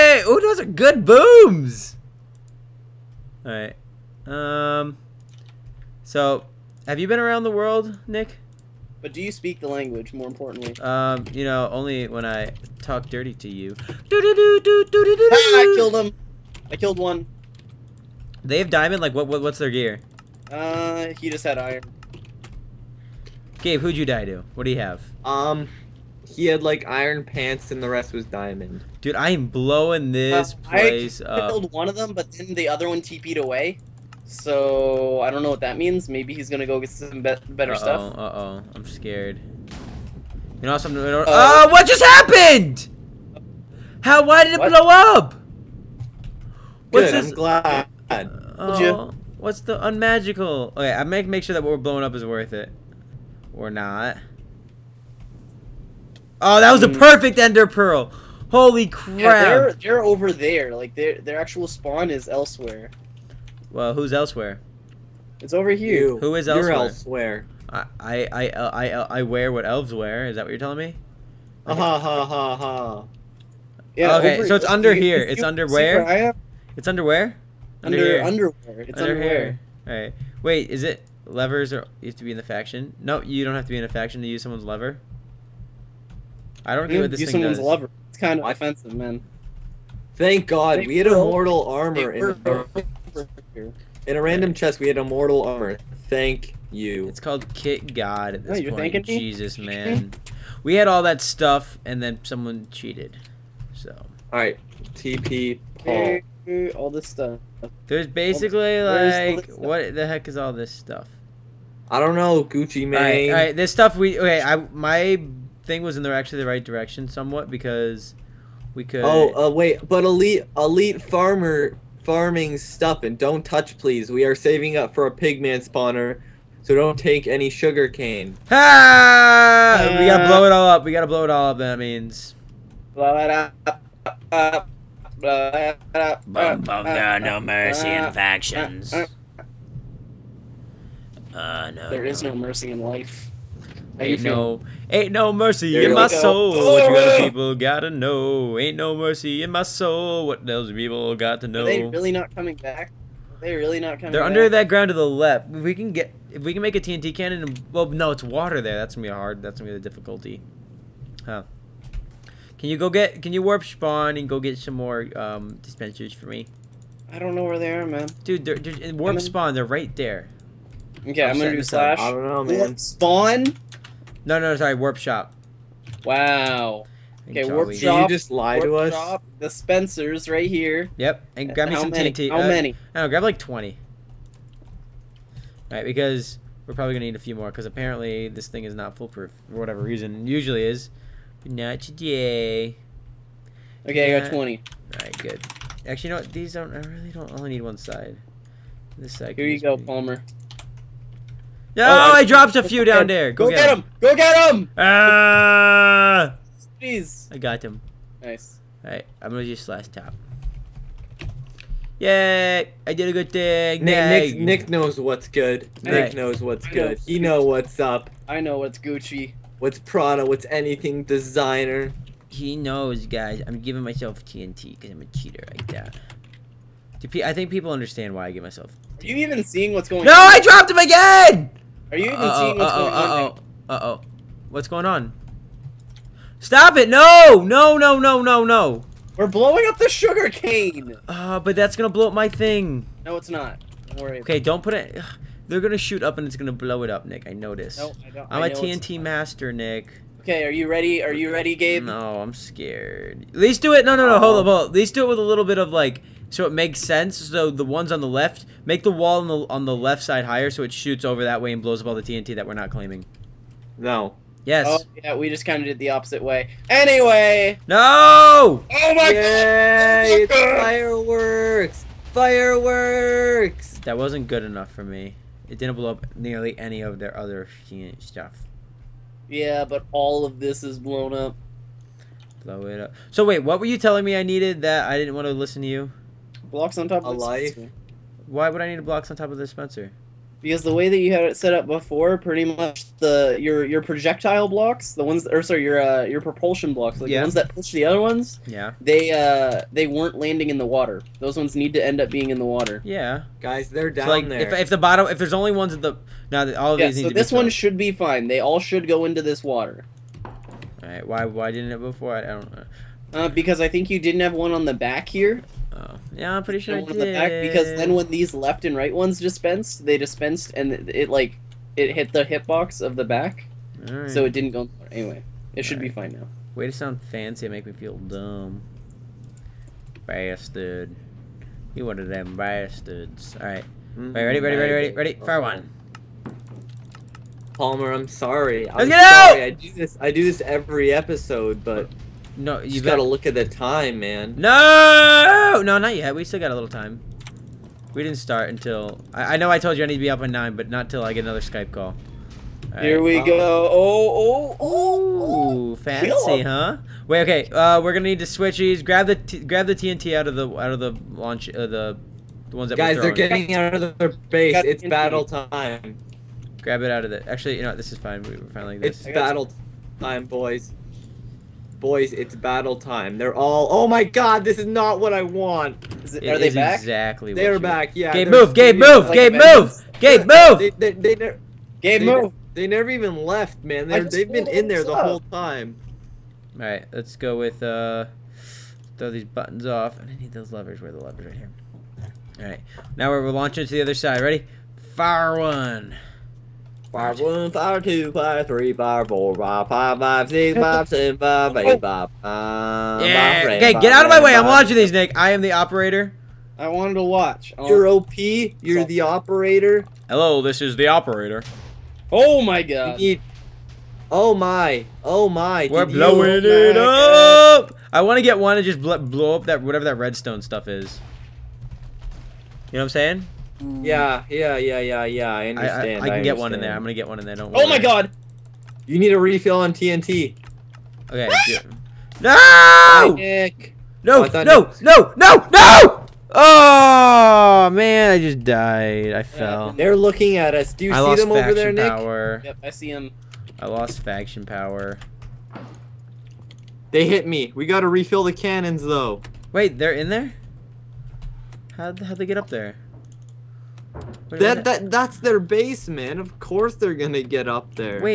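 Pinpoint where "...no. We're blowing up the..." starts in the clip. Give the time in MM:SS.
03:58.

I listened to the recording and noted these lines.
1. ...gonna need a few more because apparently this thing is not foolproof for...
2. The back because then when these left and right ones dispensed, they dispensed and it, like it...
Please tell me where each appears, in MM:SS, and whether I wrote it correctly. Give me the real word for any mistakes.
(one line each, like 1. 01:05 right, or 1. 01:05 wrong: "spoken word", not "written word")
1. 03:06 right
2. 05:16 right.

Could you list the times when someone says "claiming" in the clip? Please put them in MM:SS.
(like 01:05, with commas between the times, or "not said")
04:22.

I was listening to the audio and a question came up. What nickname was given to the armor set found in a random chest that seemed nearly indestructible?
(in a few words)
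Kit God.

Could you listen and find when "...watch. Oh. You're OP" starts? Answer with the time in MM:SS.
06:47.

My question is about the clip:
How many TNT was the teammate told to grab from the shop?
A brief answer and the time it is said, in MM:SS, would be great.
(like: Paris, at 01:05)
20, at 03:03.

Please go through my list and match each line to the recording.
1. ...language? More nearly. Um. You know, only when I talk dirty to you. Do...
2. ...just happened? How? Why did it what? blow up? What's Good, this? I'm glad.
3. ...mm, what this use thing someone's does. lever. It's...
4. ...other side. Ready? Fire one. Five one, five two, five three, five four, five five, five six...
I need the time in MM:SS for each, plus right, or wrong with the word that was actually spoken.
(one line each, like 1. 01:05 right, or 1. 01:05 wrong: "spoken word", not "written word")
1. 00:09 wrong: "importantly", not "nearly"
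2. 00:41 right
3. 01:26 right
4. 06:33 right.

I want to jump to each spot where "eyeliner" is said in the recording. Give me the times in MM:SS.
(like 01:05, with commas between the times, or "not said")
not said.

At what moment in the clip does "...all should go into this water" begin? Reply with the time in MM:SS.
05:08.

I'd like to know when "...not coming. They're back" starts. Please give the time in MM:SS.
02:33.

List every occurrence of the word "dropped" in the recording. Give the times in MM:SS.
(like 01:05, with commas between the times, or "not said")
03:22, 03:50.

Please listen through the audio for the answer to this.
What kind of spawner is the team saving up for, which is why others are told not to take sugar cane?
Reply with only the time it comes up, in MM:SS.
02:05.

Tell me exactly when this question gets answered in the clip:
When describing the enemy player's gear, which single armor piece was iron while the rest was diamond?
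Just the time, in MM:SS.
00:26.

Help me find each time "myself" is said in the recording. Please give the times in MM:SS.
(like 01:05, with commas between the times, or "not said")
03:43, 03:48.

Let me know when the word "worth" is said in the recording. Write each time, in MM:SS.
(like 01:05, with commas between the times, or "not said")
00:52.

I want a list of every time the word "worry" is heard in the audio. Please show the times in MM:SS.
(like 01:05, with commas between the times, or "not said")
04:04, 07:07.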